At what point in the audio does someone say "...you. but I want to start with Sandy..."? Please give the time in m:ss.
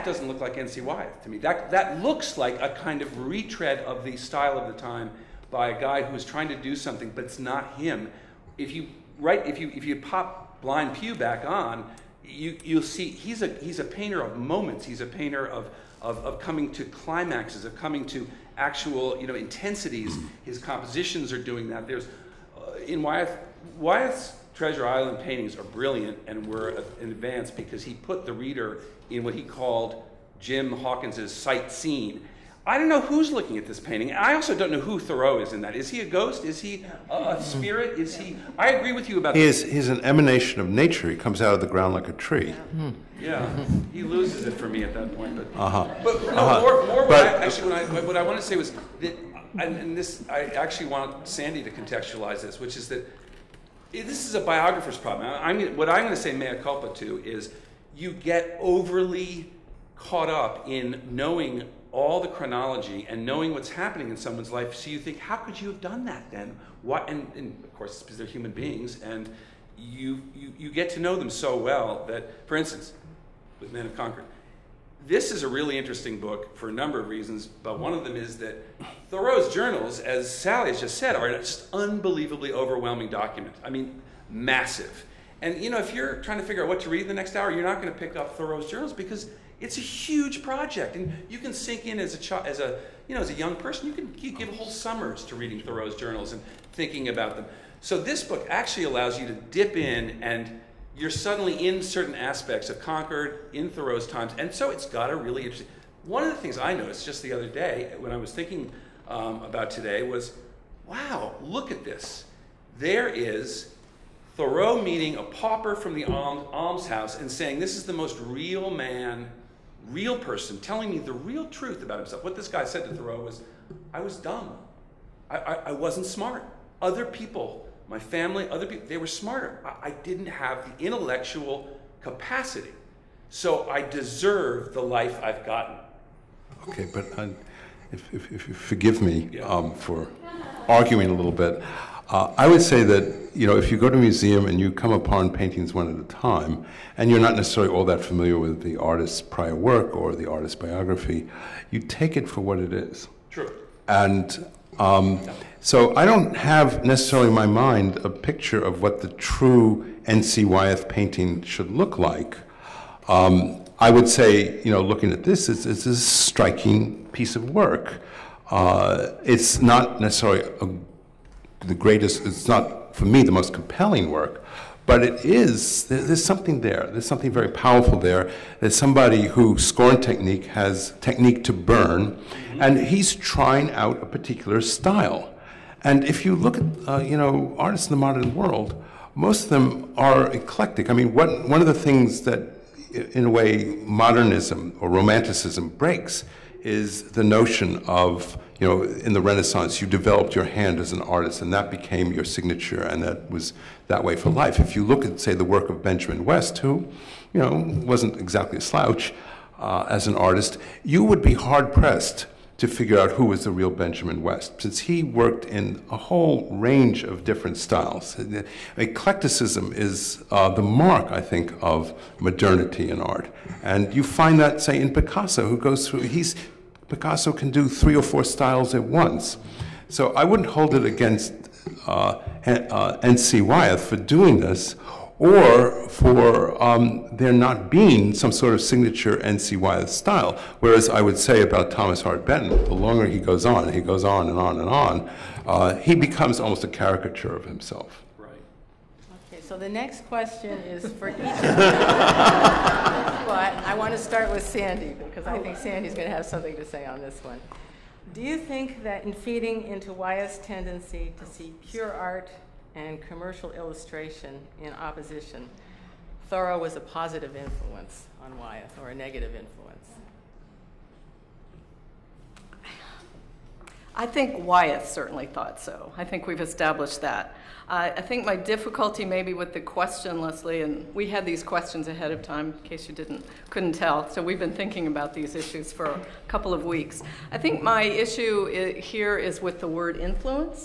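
4:11.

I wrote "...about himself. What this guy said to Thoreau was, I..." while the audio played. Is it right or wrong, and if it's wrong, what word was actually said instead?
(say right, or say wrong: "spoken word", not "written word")
right.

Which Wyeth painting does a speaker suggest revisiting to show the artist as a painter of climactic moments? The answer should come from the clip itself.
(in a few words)
Blind Pew.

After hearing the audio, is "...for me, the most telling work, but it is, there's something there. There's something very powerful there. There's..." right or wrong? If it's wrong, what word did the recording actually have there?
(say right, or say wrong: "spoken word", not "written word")
wrong: "compelling", not "telling".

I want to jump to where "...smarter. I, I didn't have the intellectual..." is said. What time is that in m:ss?
2:09.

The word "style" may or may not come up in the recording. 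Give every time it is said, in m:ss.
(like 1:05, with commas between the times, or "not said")
0:04, 3:04, 3:37, 3:48, 3:59.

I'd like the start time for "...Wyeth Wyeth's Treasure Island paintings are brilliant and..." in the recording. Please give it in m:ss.
0:23.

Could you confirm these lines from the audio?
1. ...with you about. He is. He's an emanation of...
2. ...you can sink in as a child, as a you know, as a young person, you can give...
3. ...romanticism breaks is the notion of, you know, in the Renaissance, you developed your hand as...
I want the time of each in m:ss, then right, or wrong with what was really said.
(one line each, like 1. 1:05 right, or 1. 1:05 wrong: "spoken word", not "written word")
1. 0:38 right
2. 1:31 right
3. 3:14 right.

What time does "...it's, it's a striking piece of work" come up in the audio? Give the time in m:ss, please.
2:45.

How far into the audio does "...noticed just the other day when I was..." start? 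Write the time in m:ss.
1:46.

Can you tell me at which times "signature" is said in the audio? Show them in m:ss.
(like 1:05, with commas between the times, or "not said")
3:22, 3:58.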